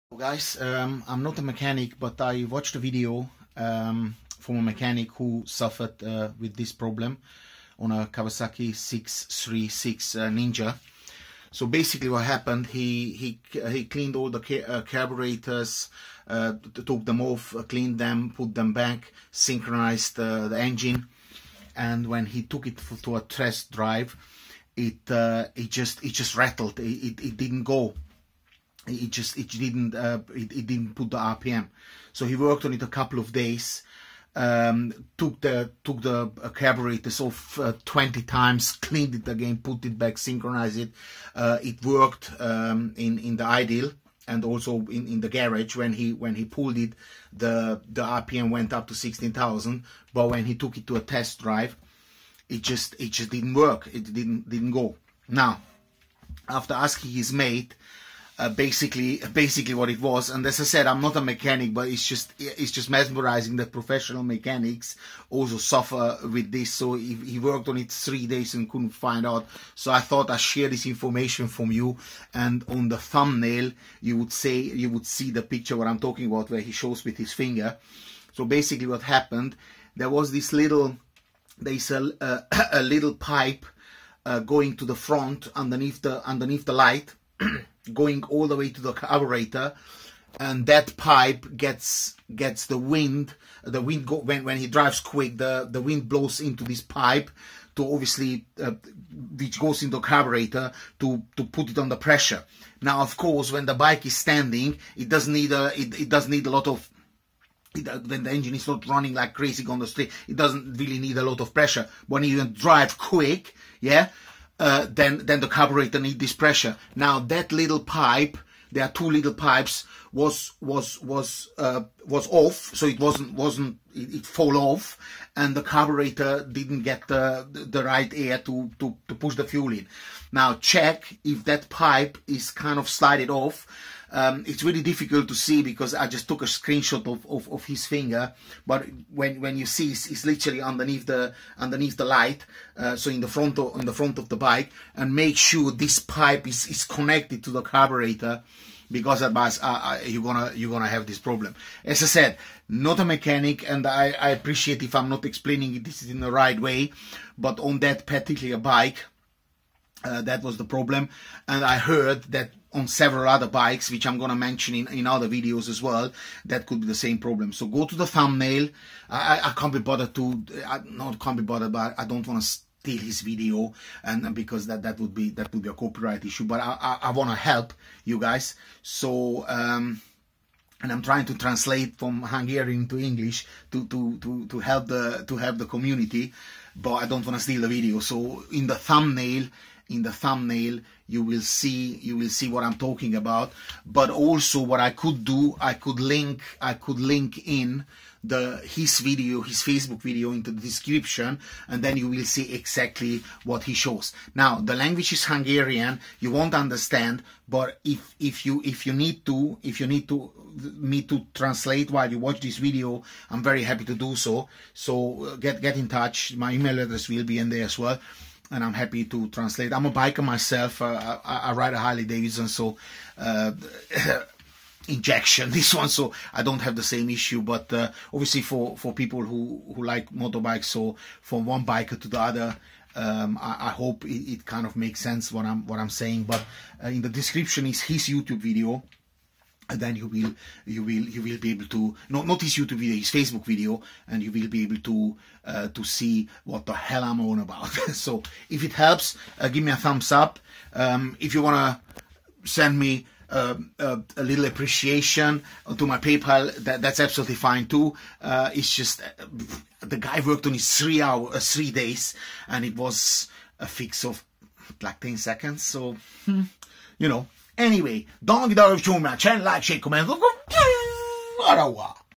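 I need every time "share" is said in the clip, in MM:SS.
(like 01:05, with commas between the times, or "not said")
01:10, 04:29.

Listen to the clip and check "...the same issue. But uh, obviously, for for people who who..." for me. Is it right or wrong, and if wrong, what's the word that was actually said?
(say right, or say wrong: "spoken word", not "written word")
right.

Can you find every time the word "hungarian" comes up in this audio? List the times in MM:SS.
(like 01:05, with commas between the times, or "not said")
03:02, 03:25.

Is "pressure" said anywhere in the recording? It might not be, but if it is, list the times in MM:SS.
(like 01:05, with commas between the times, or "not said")
01:41, 01:51, 01:56.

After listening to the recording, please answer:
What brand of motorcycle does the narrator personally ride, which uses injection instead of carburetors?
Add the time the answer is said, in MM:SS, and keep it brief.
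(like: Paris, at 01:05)
Harley Davidson, at 03:41.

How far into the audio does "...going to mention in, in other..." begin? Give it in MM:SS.
02:44.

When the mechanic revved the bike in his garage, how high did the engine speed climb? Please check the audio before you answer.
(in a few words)
16,000.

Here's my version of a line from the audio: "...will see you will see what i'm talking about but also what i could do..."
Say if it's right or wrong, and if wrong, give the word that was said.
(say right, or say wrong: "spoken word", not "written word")
right.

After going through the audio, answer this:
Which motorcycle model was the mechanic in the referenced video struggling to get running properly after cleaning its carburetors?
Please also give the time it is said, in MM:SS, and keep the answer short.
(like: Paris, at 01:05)
Kawasaki 636 Ninja, at 00:08.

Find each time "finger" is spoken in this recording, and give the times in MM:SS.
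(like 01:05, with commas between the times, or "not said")
01:17, 02:17.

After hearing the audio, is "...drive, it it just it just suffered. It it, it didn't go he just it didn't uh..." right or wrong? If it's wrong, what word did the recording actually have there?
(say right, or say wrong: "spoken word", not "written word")
wrong: "rattled", not "suffered".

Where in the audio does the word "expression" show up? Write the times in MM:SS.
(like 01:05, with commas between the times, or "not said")
not said.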